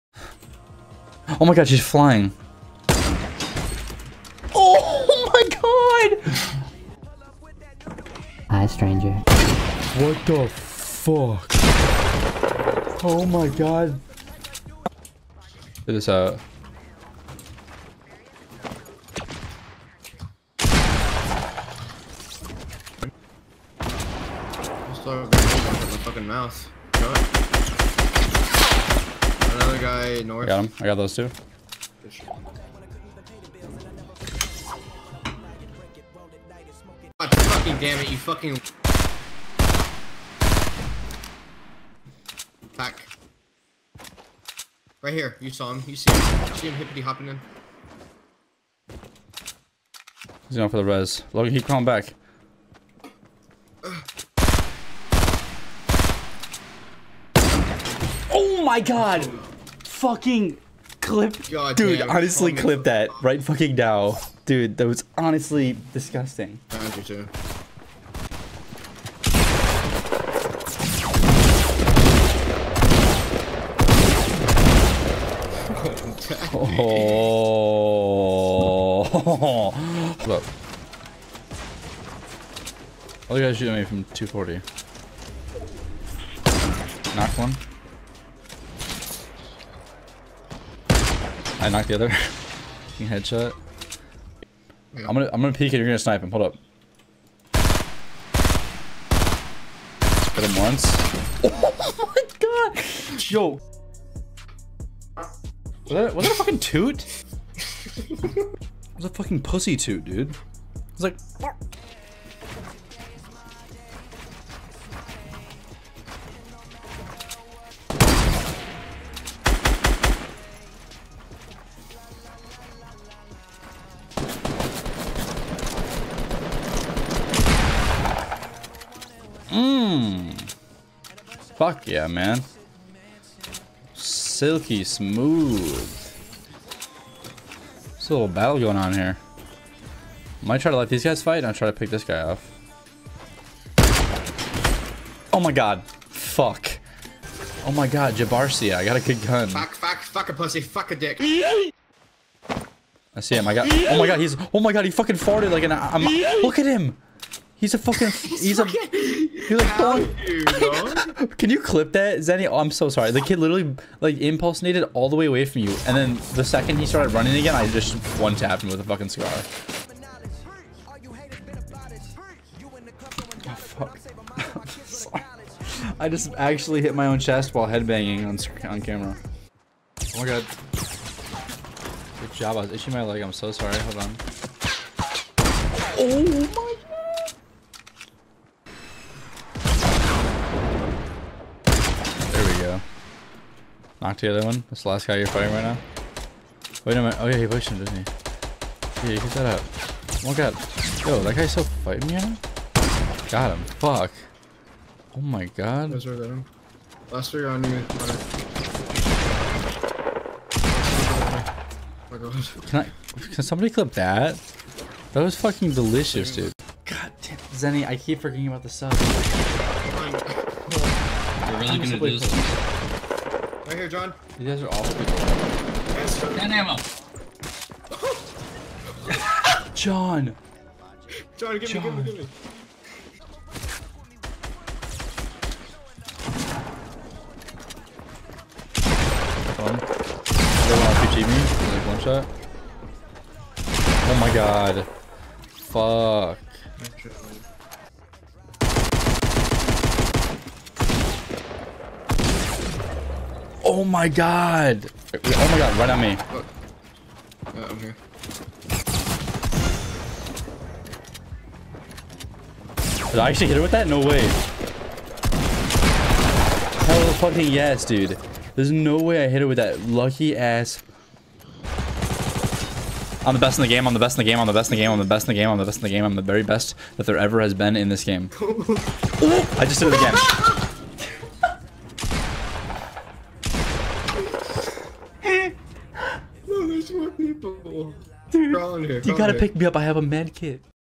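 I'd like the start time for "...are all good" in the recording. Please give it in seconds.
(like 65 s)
224 s.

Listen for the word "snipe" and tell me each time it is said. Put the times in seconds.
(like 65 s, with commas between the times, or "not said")
95 s.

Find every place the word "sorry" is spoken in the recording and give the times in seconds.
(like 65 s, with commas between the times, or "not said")
162 s, 183 s.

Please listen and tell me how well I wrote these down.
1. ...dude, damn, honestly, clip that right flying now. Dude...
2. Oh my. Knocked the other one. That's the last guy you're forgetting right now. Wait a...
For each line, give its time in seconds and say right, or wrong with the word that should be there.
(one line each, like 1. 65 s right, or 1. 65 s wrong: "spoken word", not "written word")
1. 61 s wrong: "fucking", not "flying"
2. 185 s wrong: "fighting", not "forgetting".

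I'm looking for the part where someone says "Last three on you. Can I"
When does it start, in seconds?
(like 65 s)
207 s.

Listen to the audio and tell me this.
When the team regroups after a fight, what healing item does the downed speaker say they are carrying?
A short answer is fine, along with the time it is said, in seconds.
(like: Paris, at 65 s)
med kit, at 290 s.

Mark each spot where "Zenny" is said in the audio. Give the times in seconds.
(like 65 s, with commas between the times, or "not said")
162 s, 217 s.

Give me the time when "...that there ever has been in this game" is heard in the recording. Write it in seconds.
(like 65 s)
276 s.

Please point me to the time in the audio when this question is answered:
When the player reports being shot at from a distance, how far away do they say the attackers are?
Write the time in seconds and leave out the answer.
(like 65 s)
84 s.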